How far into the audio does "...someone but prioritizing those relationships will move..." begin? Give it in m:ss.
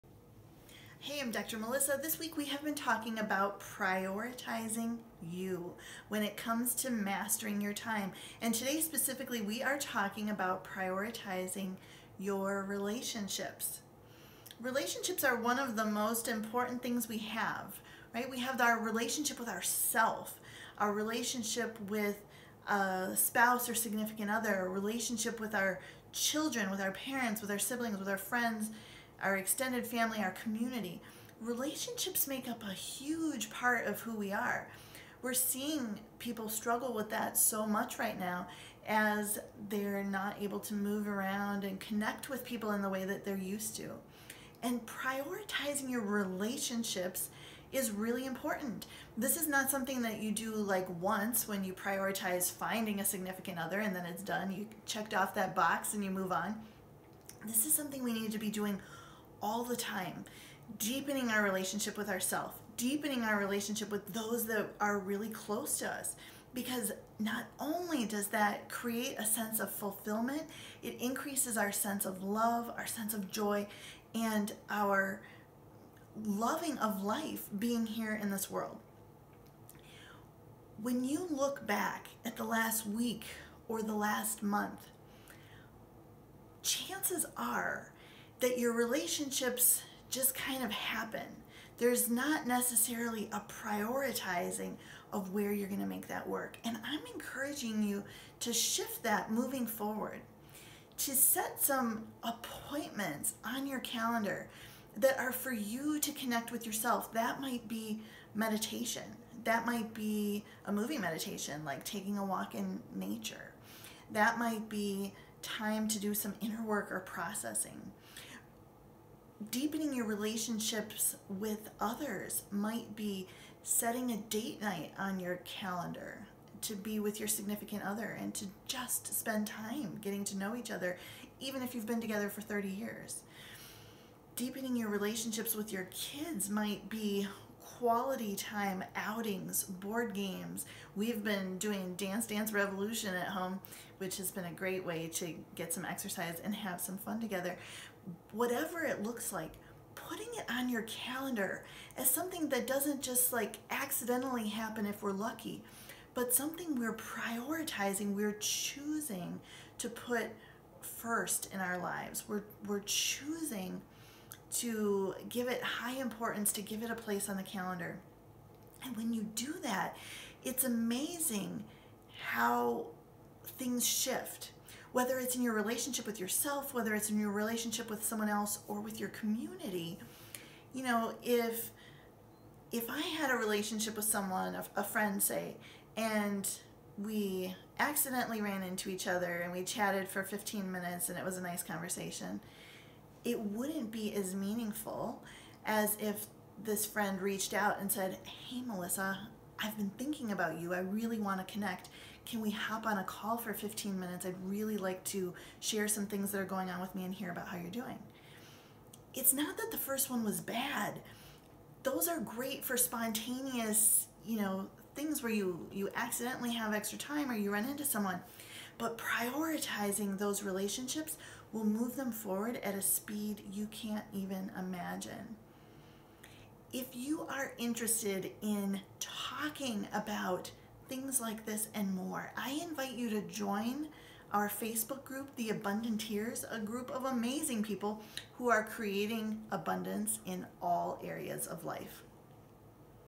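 3:37.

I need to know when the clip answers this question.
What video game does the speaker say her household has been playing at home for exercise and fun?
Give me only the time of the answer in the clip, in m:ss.
2:21.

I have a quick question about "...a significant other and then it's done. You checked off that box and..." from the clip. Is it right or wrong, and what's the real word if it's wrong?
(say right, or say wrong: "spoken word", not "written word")
right.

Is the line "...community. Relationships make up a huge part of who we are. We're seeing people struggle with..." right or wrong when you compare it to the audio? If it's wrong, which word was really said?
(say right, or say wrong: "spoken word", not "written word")
right.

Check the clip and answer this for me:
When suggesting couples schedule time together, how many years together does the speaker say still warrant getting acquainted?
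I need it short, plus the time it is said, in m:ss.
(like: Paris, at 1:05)
30, at 2:12.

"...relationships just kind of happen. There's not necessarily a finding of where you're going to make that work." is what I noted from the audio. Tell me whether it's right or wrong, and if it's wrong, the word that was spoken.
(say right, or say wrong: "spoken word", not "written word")
wrong: "prioritizing", not "finding".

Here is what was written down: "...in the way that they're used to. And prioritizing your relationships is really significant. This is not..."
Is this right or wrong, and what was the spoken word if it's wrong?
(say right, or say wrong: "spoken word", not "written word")
wrong: "important", not "significant".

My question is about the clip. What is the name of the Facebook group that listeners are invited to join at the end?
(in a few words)
The Abundanteers.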